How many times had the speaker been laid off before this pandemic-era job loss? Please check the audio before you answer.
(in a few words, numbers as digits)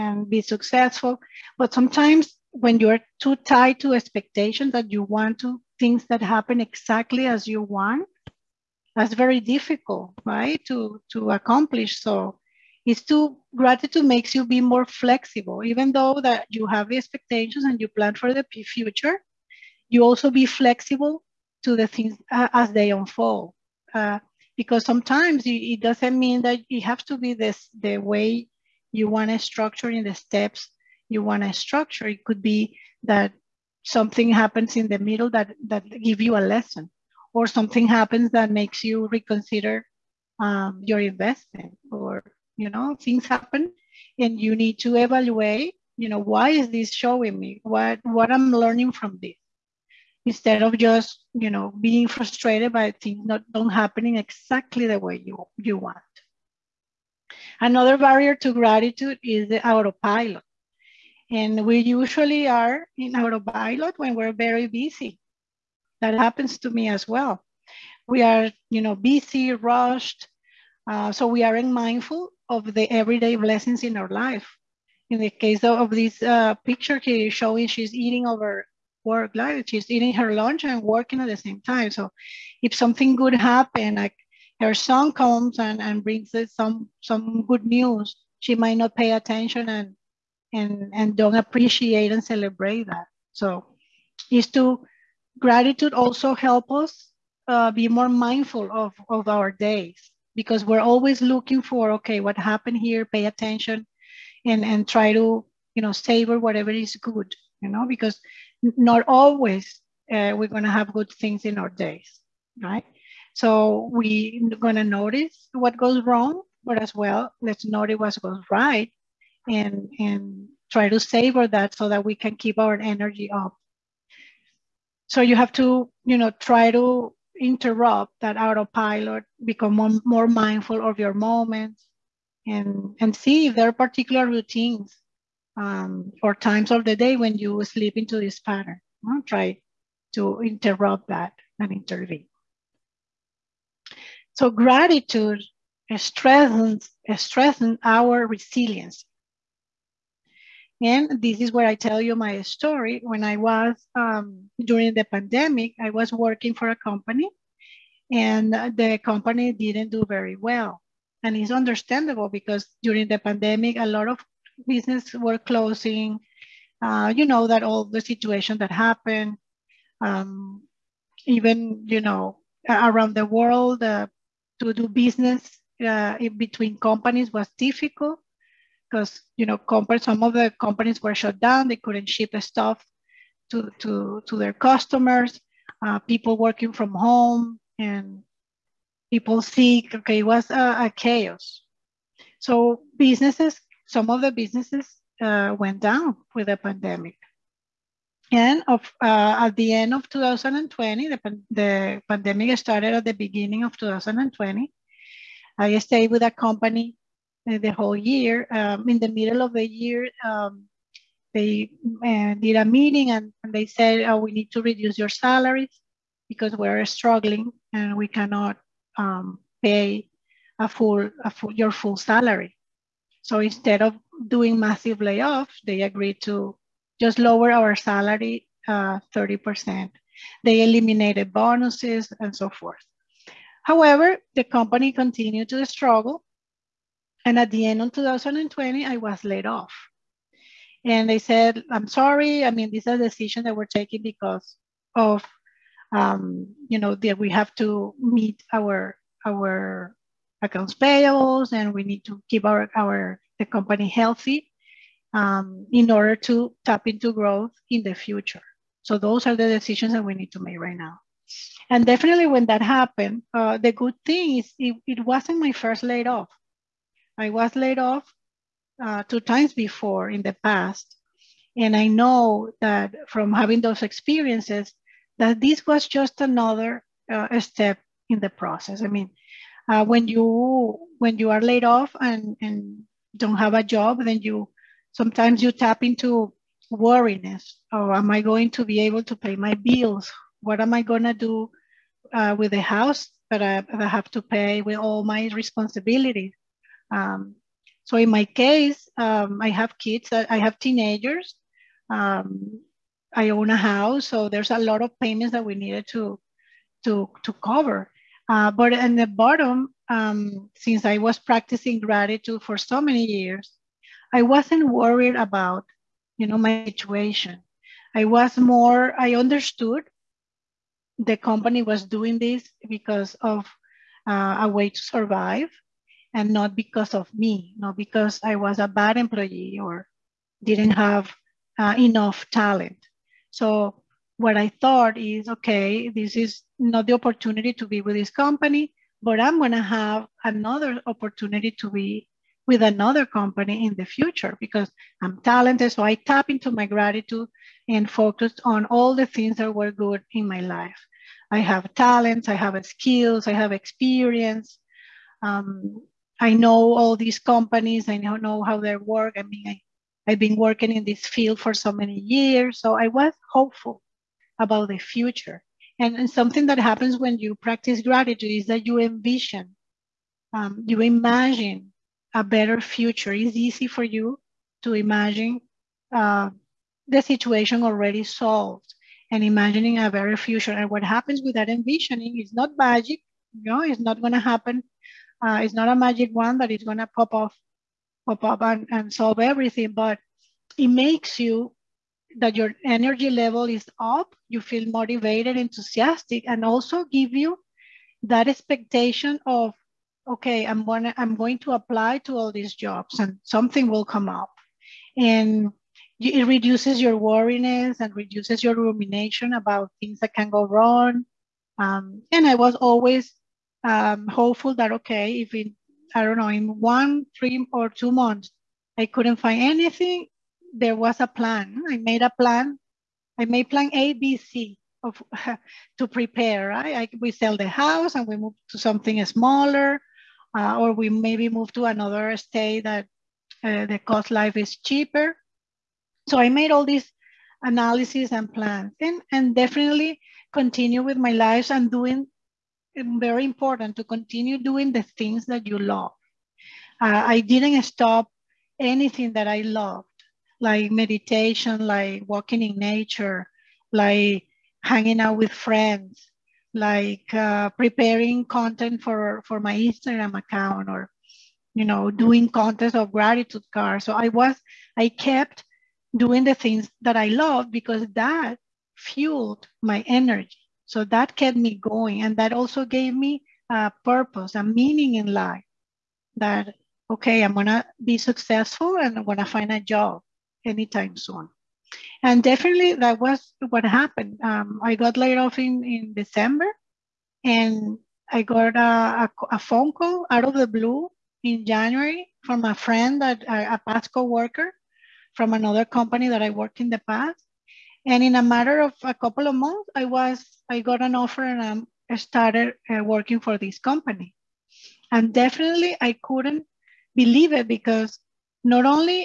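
2.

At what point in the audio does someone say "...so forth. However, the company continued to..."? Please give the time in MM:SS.
03:52.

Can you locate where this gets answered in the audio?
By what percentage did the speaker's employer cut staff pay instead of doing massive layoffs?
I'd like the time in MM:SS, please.
03:49.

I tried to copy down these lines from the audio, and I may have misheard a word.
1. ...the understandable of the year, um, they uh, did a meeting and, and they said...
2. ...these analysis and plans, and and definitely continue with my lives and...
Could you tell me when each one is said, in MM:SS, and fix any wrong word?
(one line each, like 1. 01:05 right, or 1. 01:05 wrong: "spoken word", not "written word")
1. 03:28 wrong: "middle", not "understandable"
2. 07:16 right.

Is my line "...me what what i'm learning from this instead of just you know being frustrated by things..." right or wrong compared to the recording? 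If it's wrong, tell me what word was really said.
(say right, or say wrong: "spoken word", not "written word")
right.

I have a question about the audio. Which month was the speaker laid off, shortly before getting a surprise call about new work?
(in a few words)
December.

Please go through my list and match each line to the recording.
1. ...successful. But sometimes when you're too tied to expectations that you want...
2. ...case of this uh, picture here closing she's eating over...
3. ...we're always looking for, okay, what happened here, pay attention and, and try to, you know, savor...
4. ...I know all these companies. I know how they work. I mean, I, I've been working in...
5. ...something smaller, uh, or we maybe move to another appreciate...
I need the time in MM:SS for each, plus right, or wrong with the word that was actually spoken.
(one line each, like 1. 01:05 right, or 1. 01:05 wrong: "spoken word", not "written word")
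1. 00:00 right
2. 01:15 wrong: "showing", not "closing"
3. 01:40 right
4. 05:56 right
5. 07:08 wrong: "state", not "appreciate".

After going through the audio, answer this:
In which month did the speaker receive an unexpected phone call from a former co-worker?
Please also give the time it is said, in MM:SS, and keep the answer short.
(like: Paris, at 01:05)
January, at 08:11.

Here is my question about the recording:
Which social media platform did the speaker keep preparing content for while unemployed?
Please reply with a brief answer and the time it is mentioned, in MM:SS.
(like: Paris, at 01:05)
Instagram, at 07:39.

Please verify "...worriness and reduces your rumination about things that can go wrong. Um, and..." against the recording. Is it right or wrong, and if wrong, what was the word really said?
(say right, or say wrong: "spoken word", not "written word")
right.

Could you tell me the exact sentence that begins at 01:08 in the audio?
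We are, you know, busy, rushed.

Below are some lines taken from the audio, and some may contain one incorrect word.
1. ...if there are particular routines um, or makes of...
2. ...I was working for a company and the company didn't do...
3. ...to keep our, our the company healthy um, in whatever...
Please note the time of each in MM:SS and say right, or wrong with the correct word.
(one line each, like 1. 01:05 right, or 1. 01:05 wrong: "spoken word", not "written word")
1. 02:13 wrong: "times", not "makes"
2. 02:35 right
3. 04:12 wrong: "order", not "whatever".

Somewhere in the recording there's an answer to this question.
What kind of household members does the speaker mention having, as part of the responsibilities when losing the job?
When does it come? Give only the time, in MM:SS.
05:00.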